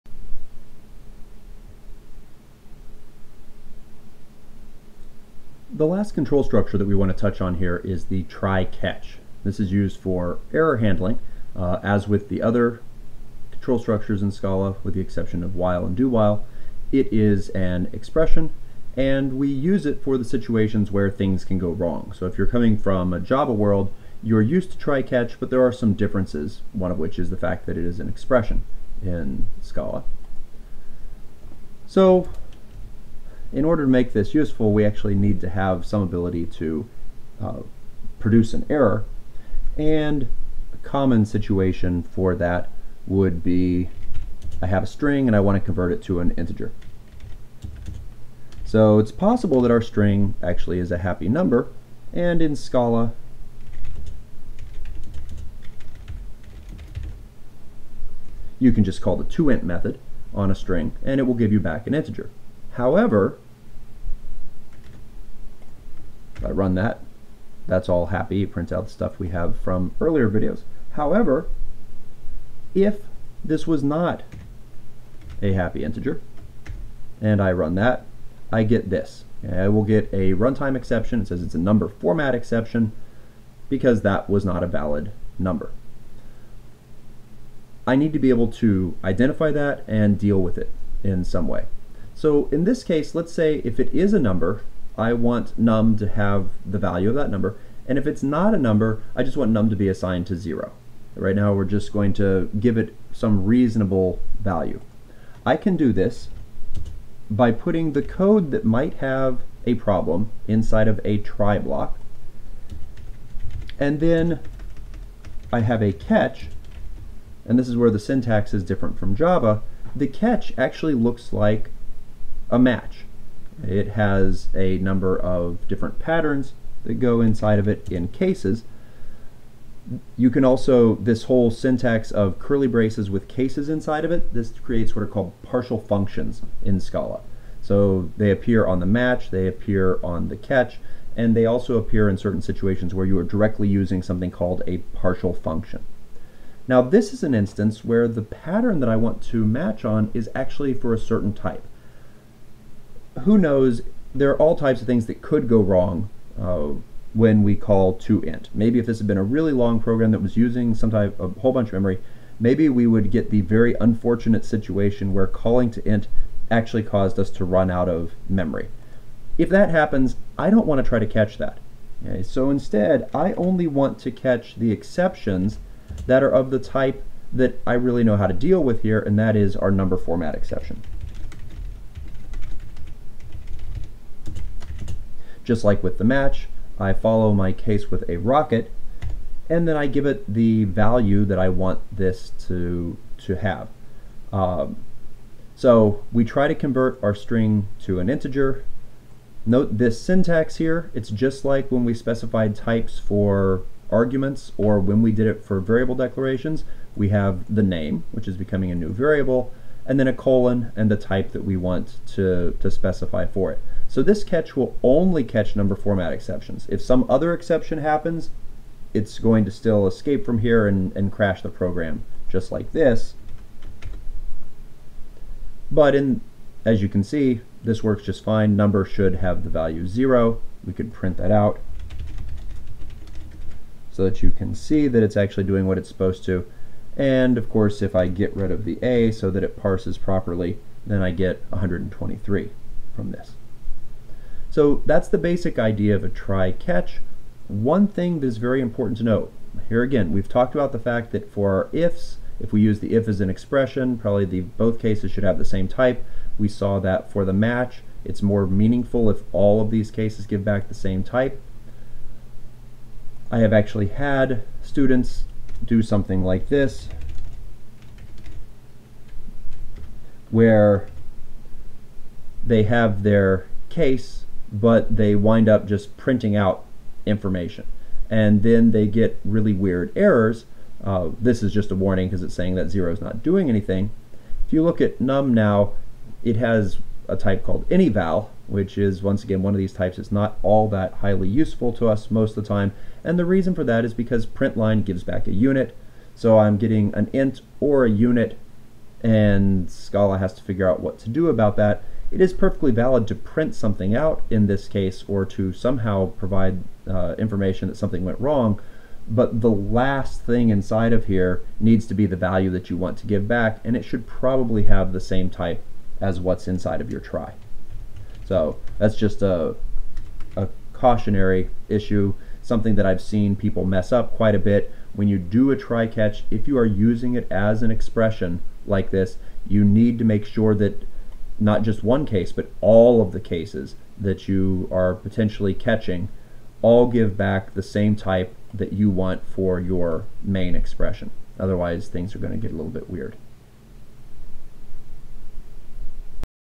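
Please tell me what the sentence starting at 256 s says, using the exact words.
We saw that for the match, it's more meaningful if all of these cases give back the same type.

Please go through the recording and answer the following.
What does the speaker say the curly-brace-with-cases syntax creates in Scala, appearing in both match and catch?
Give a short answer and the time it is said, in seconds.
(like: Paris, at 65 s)
partial functions, at 135 s.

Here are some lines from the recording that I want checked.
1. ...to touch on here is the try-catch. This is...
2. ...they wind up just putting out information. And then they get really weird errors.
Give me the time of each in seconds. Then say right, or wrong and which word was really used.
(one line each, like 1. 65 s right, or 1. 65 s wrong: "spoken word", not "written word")
1. 7 s right
2. 274 s wrong: "printing", not "putting".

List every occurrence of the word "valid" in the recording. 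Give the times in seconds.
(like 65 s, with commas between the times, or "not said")
84 s, 302 s.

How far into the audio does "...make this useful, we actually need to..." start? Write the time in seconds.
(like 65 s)
33 s.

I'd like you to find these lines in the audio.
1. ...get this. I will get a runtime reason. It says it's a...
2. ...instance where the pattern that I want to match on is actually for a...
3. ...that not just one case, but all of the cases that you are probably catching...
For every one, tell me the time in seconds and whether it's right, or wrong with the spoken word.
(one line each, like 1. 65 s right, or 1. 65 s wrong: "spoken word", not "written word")
1. 78 s wrong: "exception", not "reason"
2. 147 s right
3. 330 s wrong: "potentially", not "probably".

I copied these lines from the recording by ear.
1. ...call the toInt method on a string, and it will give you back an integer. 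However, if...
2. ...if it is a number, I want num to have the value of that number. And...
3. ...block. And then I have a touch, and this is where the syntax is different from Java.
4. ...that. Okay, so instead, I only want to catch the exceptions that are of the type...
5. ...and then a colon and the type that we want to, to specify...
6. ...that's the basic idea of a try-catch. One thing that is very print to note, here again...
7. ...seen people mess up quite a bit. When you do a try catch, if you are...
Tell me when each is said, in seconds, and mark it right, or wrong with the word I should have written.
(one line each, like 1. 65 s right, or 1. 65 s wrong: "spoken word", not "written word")
1. 59 s right
2. 93 s right
3. 111 s wrong: "catch", not "touch"
4. 171 s right
5. 209 s right
6. 244 s wrong: "important", not "print"
7. 323 s right.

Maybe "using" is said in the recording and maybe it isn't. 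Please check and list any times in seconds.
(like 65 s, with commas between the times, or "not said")
143 s, 160 s, 326 s.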